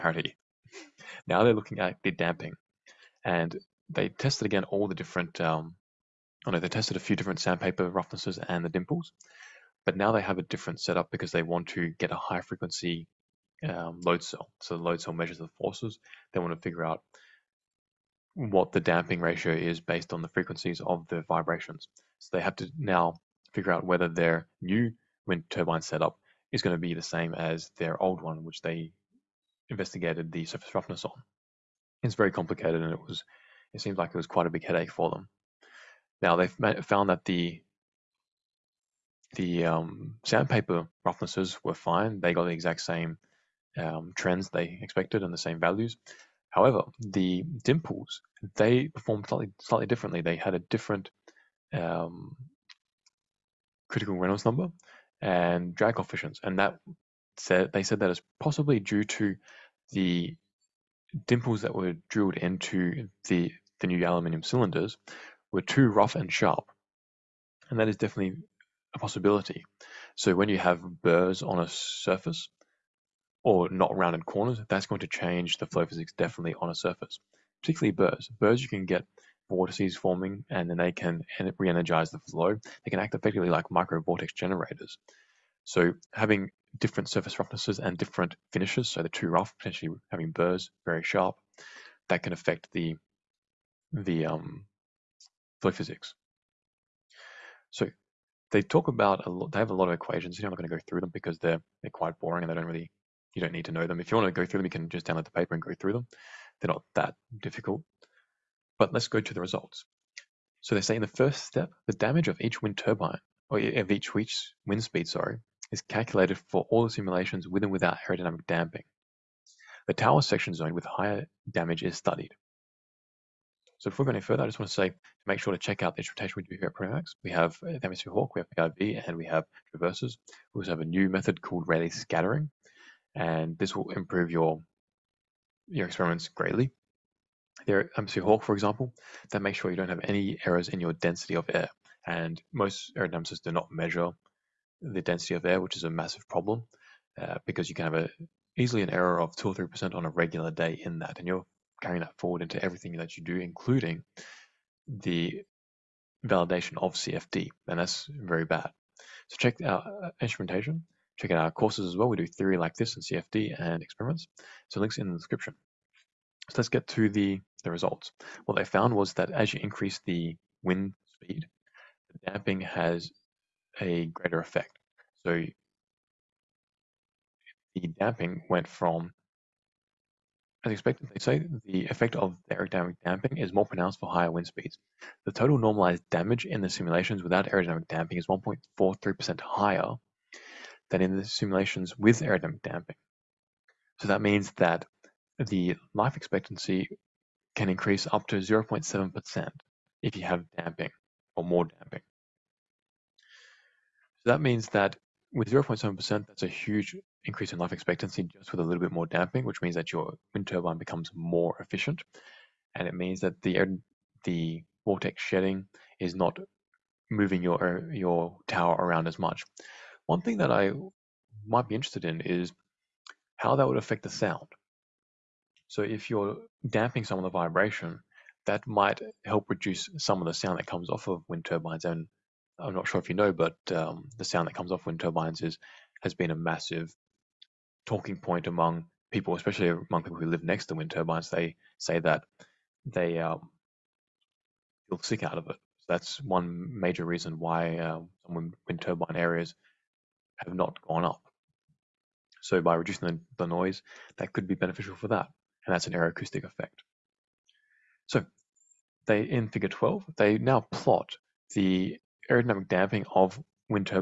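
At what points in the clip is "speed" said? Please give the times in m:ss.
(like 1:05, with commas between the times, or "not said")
1:54, 2:51, 3:04.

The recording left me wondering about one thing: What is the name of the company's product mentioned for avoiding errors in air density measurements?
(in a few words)
MC Hawk.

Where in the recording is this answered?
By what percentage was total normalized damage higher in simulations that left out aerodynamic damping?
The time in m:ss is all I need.
3:08.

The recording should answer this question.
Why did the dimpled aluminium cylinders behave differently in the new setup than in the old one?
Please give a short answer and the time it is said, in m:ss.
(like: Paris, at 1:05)
too rough and sharp, at 1:05.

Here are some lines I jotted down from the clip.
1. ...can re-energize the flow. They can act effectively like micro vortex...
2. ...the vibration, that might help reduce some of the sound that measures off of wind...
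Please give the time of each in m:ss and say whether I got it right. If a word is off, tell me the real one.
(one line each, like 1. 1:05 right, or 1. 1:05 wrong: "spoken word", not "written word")
1. 1:20 right
2. 3:47 wrong: "comes", not "measures".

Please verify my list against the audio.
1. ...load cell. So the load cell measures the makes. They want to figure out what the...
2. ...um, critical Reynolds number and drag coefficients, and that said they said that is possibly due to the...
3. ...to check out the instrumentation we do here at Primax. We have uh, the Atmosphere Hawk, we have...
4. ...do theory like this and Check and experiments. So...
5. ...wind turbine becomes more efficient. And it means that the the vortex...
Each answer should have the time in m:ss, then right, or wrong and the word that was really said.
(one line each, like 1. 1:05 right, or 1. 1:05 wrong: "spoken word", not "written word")
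1. 0:14 wrong: "forces", not "makes"
2. 0:51 right
3. 2:05 right
4. 2:42 wrong: "CFD", not "Check"
5. 3:30 right.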